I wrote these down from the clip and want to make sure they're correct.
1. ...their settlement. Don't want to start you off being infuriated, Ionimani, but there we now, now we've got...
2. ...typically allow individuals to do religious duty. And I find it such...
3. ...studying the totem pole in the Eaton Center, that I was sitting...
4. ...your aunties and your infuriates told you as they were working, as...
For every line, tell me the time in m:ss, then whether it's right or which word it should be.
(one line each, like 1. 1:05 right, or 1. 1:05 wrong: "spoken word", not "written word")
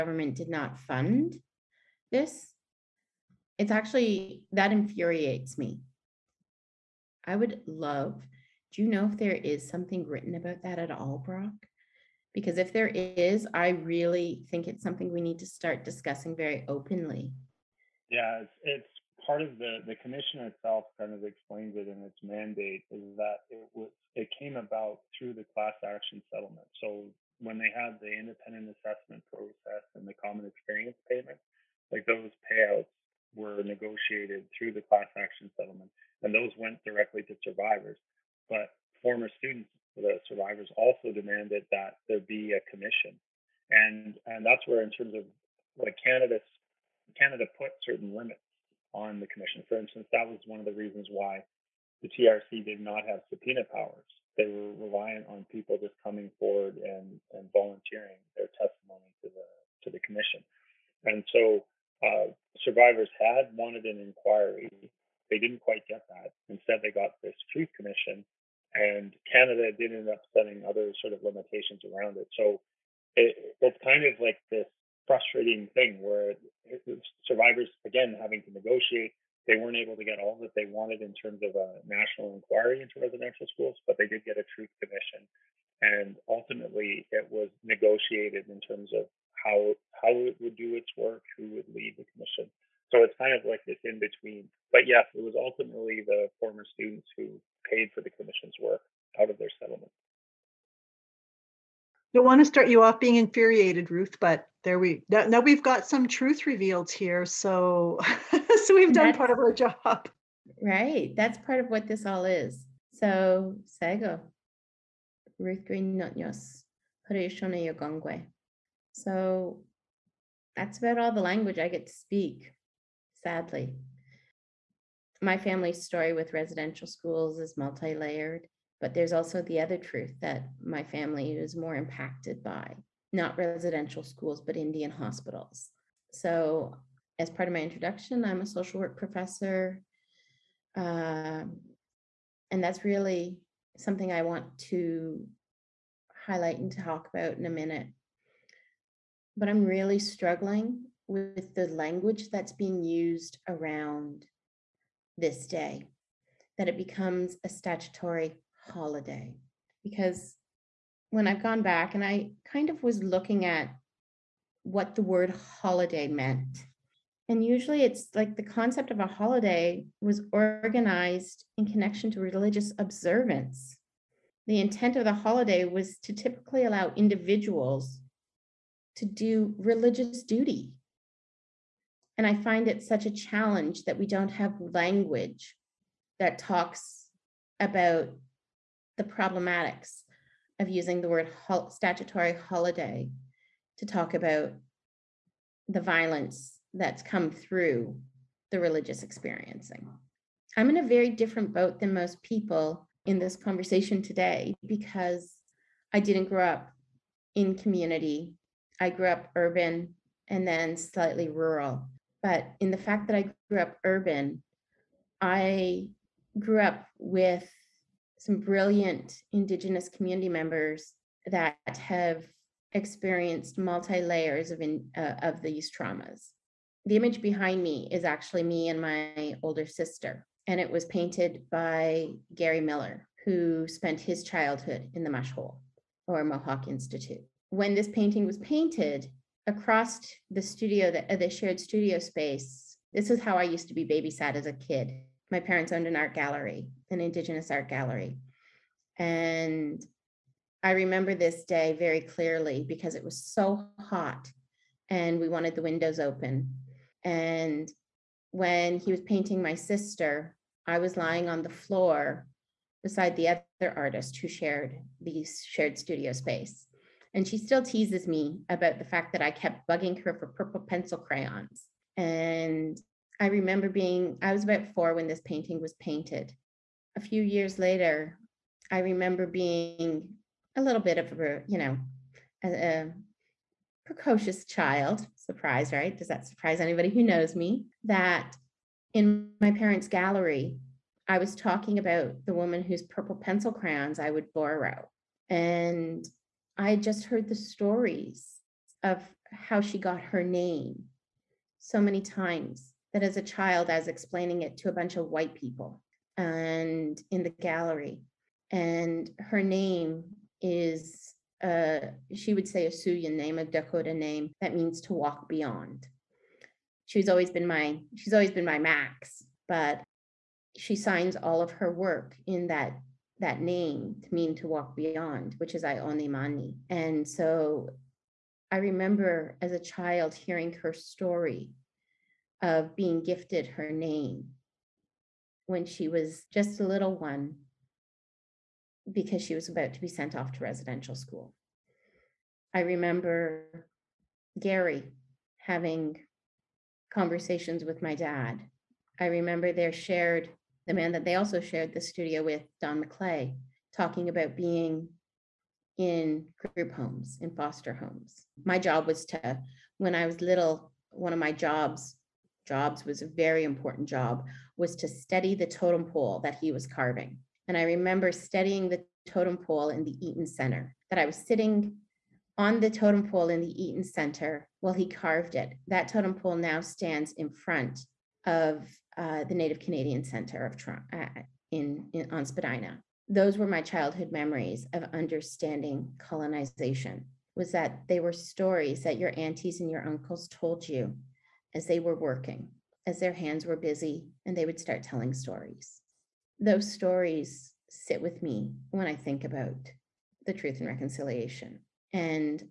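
1. 1:39 wrong: "Ruth", not "Ionimani"
2. 2:56 right
3. 6:08 right
4. 6:28 wrong: "uncles", not "infuriates".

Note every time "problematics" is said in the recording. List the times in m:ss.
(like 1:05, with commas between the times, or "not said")
3:09.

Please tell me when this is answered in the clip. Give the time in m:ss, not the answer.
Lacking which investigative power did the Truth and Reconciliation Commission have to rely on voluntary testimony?
0:53.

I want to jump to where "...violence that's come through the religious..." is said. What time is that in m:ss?
3:15.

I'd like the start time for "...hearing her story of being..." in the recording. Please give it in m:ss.
5:30.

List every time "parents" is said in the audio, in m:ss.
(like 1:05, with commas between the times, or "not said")
4:05, 4:49.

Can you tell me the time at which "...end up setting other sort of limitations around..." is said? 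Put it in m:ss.
1:09.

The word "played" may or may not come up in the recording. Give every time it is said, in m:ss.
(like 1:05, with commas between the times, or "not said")
not said.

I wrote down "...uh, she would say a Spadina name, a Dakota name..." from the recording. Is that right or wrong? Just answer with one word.
wrong.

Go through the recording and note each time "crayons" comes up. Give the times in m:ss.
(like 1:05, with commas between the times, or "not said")
4:30, 4:53.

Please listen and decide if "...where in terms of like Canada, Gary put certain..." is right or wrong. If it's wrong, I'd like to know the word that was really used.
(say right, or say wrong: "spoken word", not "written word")
wrong: "Canada", not "Gary".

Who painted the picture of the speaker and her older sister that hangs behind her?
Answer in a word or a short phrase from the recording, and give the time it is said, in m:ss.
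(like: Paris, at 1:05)
Gary Miller, at 3:52.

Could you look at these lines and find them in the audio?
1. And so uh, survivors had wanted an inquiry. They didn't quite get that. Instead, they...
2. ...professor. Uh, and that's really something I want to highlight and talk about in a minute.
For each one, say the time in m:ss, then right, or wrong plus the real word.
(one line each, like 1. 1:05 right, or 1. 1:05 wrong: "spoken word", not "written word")
1. 1:01 right
2. 2:18 right.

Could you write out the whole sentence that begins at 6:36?
Those stories sit with me when I think about the truth and reconciliation.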